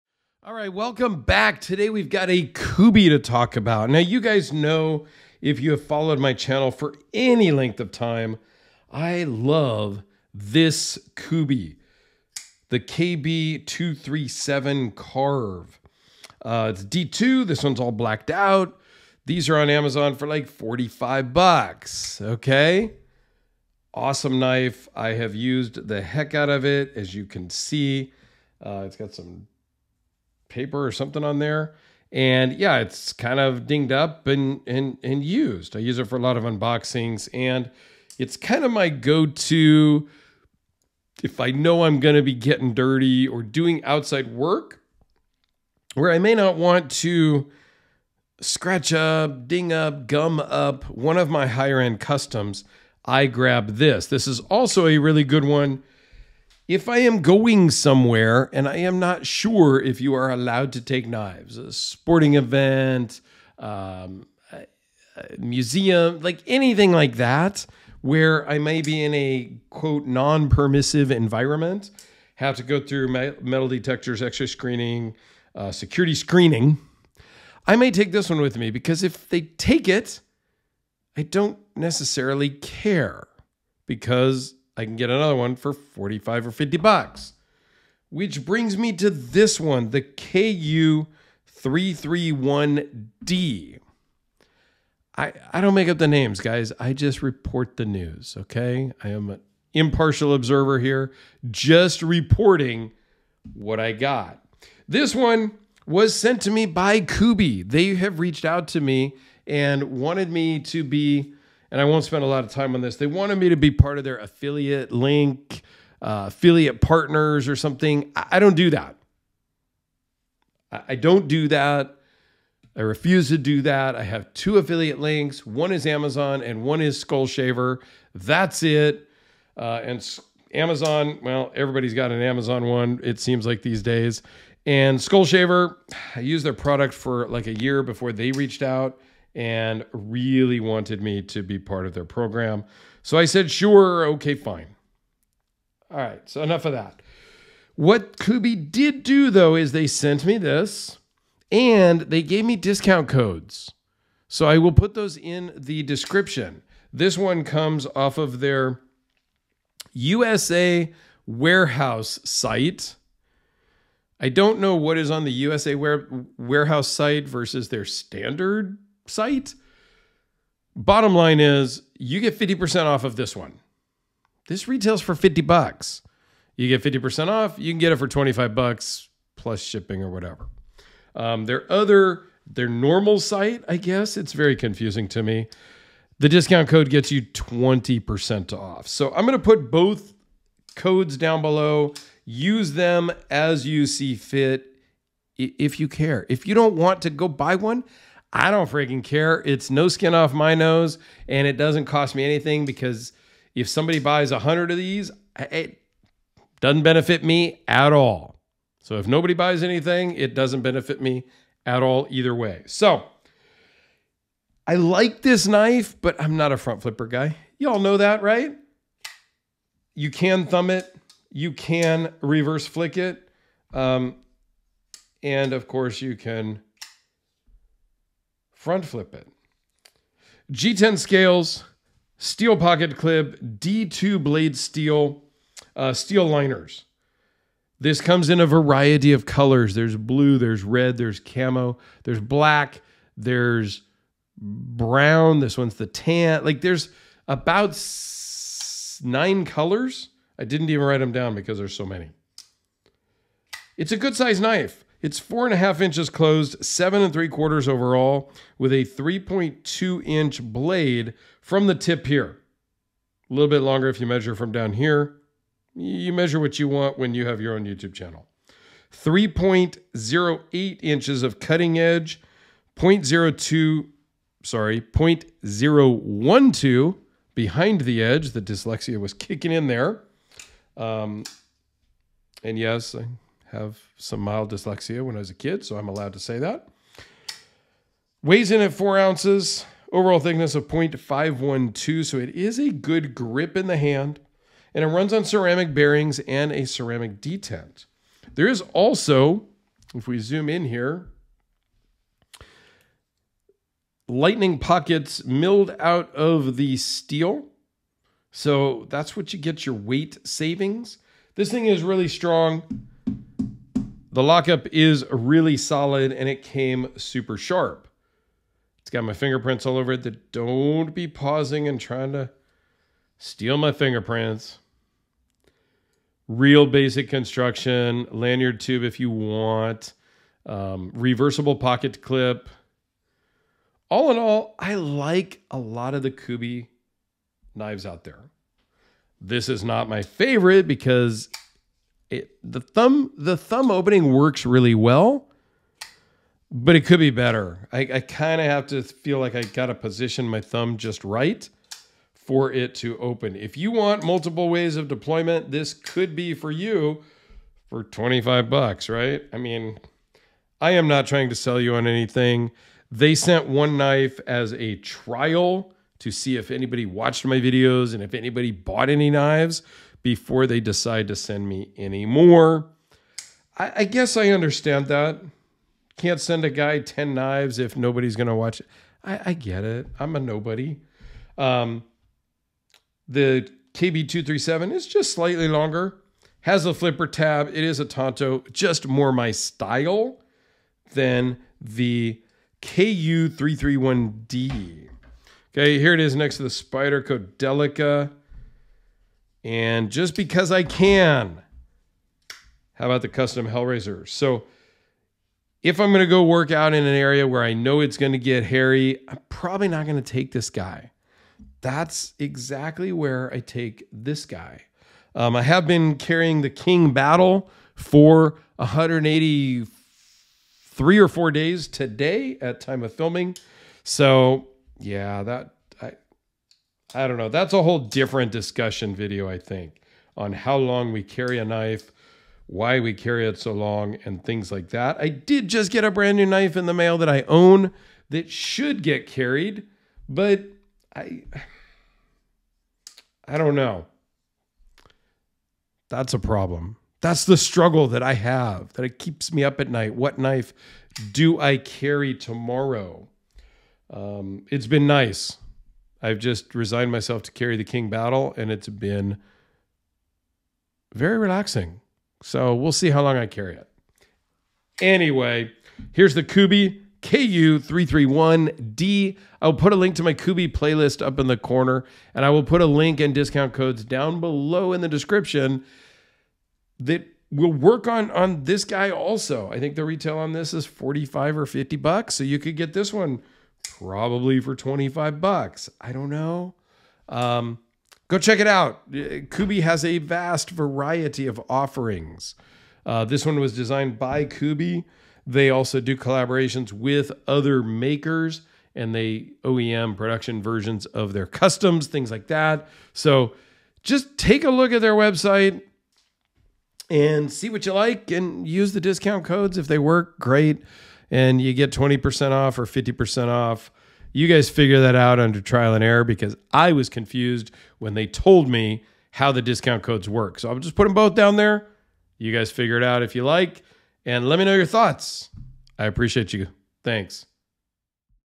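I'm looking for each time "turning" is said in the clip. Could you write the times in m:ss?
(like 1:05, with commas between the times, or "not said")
not said.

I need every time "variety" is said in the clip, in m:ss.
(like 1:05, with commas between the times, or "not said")
3:58, 8:10.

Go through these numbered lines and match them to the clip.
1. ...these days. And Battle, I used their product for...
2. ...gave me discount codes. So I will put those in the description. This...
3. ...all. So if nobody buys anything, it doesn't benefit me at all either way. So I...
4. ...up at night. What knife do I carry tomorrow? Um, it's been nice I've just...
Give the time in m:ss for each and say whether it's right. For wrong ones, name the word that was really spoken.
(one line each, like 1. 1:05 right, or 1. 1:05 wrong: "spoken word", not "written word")
1. 2:13 wrong: "Skullshaver", not "Battle"
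2. 2:32 right
3. 3:27 right
4. 7:29 right.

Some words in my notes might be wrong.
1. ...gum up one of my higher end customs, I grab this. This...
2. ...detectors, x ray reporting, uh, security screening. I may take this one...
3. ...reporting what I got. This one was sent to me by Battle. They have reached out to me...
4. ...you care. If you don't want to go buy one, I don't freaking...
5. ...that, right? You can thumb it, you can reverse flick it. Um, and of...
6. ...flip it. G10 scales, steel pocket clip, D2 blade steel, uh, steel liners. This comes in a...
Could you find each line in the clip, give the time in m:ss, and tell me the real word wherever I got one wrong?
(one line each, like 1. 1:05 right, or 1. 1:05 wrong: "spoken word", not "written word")
1. 0:50 right
2. 1:13 wrong: "screening", not "reporting"
3. 1:42 wrong: "Kubey", not "Battle"
4. 3:15 right
5. 3:37 right
6. 3:48 right.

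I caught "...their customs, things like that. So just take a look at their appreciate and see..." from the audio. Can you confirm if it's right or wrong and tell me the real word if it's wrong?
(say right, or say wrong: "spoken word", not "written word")
wrong: "website", not "appreciate".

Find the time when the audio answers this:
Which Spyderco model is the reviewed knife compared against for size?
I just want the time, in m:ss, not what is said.
6:37.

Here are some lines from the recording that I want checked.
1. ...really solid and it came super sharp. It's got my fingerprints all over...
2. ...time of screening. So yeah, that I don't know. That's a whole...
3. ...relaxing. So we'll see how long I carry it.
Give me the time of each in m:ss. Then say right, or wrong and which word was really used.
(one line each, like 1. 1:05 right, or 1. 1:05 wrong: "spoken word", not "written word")
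1. 5:15 right
2. 7:02 wrong: "filming", not "screening"
3. 7:41 right.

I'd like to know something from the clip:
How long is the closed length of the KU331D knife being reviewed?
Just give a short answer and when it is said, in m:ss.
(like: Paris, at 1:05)
4.5 inches, at 4:15.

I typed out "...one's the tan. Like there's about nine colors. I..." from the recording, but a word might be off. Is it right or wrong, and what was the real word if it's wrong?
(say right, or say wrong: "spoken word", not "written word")
right.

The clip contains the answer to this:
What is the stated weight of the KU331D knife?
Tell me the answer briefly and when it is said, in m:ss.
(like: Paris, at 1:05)
4 ounces, at 4:48.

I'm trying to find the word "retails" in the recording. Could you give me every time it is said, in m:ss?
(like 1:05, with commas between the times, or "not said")
2:54, 7:59.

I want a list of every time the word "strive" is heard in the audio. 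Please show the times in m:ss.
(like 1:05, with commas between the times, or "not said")
not said.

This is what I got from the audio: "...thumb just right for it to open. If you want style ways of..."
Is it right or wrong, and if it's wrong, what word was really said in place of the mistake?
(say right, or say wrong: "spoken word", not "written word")
wrong: "multiple", not "style".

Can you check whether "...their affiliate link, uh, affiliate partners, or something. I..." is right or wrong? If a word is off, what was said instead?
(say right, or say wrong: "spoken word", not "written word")
right.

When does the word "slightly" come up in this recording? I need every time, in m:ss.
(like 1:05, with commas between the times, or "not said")
6:25.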